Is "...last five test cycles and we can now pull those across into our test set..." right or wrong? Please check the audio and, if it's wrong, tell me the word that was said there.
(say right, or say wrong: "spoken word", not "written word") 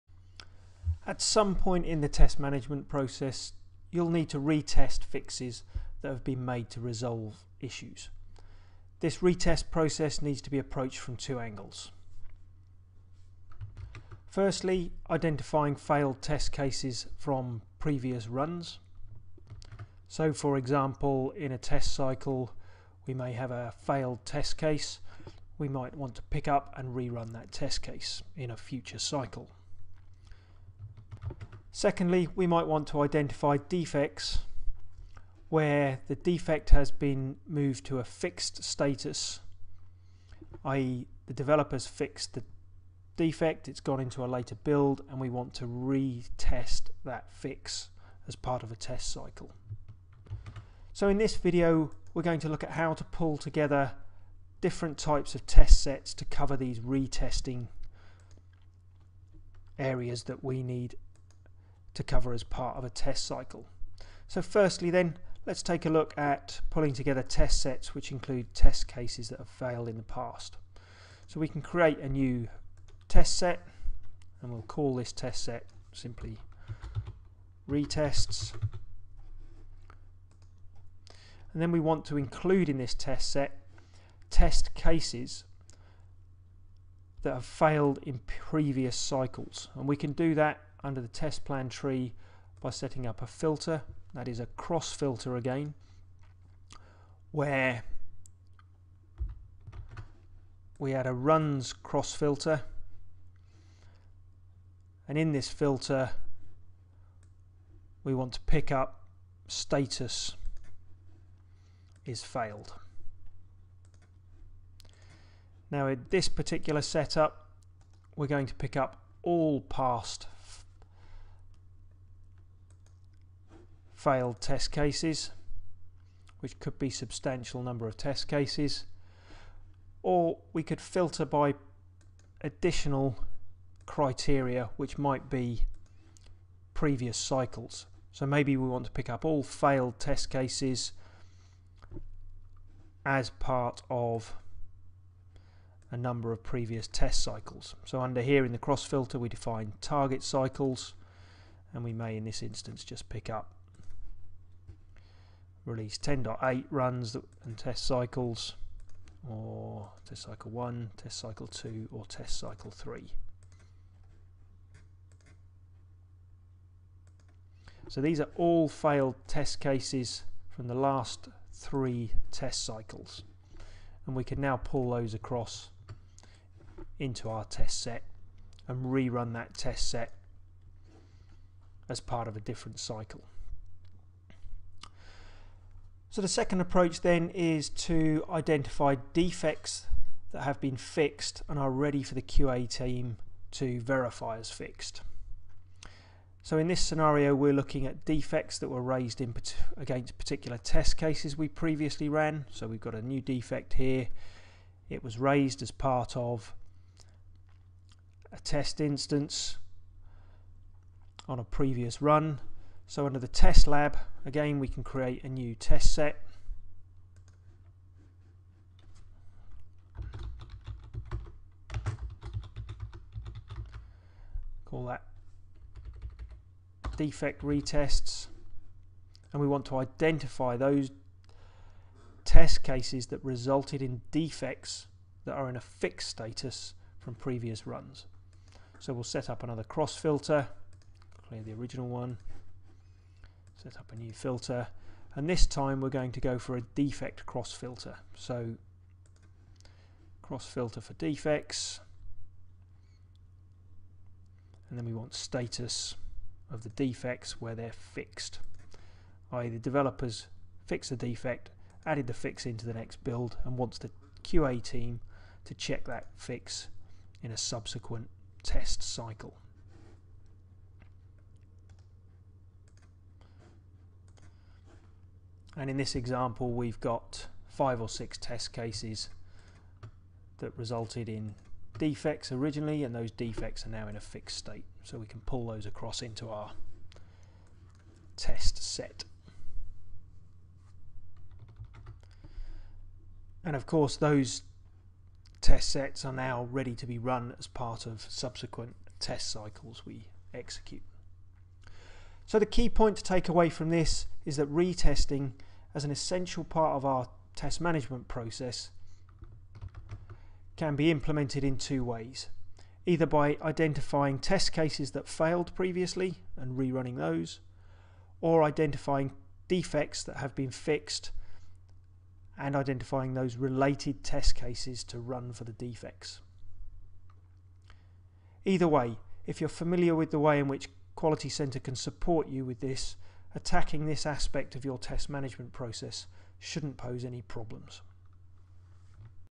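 wrong: "three", not "five".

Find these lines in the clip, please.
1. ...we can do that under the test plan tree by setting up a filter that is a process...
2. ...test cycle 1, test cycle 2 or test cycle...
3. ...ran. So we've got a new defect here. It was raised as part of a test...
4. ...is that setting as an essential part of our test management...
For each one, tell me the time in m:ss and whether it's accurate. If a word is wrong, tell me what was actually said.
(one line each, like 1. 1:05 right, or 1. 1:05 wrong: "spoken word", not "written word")
1. 1:29 wrong: "cross", not "process"
2. 2:40 right
3. 3:22 right
4. 5:04 wrong: "retesting", not "setting".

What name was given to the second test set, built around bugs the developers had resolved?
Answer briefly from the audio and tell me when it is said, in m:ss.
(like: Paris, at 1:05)
defect retests, at 3:46.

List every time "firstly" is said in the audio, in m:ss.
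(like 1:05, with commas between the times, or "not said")
0:14, 1:04.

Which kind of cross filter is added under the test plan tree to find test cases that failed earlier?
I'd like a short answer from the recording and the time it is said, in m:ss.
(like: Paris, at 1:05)
runs cross filter, at 1:41.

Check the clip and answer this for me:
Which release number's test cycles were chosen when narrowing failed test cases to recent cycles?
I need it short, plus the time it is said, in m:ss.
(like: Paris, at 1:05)
10.8, at 2:35.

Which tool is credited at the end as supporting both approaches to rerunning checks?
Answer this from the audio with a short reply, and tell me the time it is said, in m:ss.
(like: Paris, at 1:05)
Quality Center, at 5:31.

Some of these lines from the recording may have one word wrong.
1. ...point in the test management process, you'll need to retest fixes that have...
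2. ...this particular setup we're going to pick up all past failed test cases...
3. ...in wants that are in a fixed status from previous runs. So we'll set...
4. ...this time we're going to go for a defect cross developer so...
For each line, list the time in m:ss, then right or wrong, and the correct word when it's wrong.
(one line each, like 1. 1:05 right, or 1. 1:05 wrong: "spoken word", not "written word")
1. 0:01 right
2. 1:56 right
3. 3:53 wrong: "defects", not "wants"
4. 4:05 wrong: "filter", not "developer".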